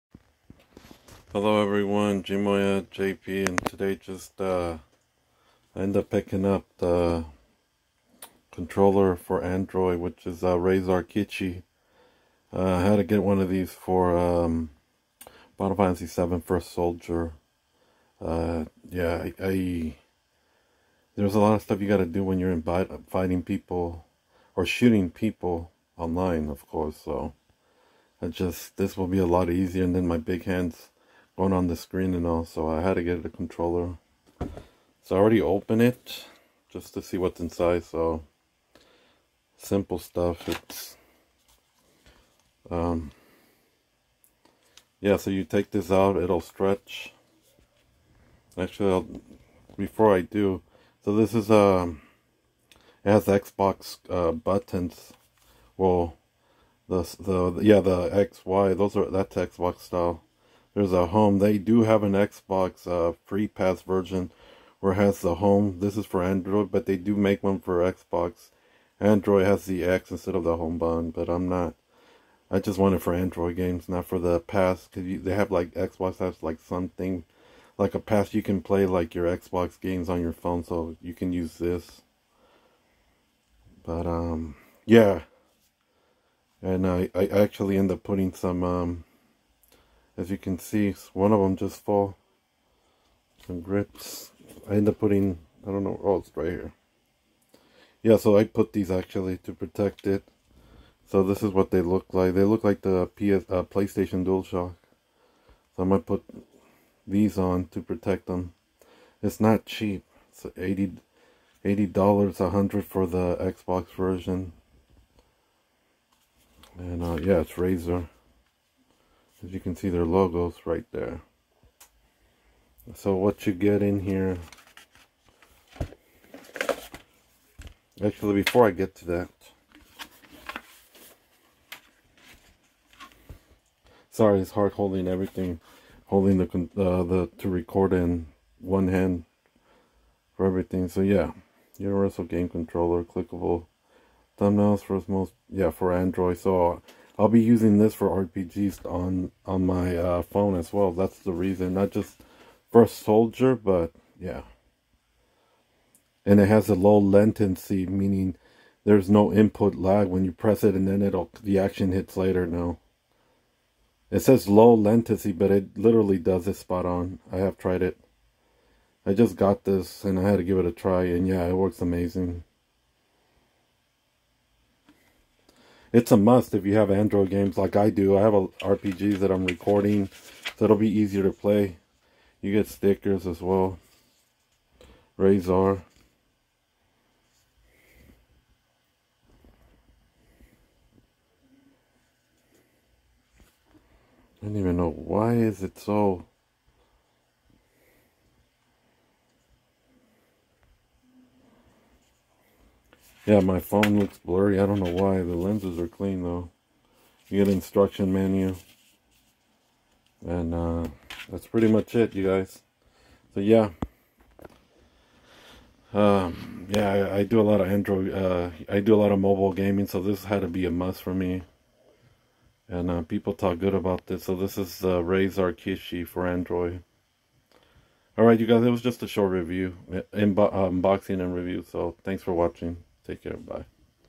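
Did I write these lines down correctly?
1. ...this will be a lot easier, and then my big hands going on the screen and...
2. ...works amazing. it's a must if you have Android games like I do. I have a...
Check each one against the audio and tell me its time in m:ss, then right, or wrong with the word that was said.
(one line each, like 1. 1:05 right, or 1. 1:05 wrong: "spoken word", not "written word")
1. 0:28 right
2. 2:51 right.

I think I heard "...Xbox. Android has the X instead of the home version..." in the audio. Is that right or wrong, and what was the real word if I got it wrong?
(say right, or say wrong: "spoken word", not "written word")
wrong: "button", not "version".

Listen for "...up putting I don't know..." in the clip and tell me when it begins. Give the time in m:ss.
1:34.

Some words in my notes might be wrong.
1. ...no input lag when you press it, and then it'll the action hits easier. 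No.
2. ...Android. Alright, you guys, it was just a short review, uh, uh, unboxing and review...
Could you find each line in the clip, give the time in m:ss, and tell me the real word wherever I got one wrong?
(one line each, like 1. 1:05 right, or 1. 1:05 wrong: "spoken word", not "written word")
1. 2:39 wrong: "later", not "easier"
2. 3:46 right.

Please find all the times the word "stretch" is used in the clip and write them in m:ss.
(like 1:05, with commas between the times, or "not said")
0:46.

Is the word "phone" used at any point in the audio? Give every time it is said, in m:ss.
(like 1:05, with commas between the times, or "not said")
1:20, 2:30, 3:23.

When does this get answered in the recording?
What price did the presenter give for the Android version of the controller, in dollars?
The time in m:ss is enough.
1:51.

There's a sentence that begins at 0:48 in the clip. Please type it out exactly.
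Actually, I'll, before I do, so this is um it has Xbox uh, buttons.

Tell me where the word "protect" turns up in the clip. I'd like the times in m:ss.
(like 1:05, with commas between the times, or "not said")
1:39, 1:47.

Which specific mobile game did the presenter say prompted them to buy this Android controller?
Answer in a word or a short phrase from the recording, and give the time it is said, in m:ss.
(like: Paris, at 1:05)
Final Fantasy VII First Soldier, at 0:15.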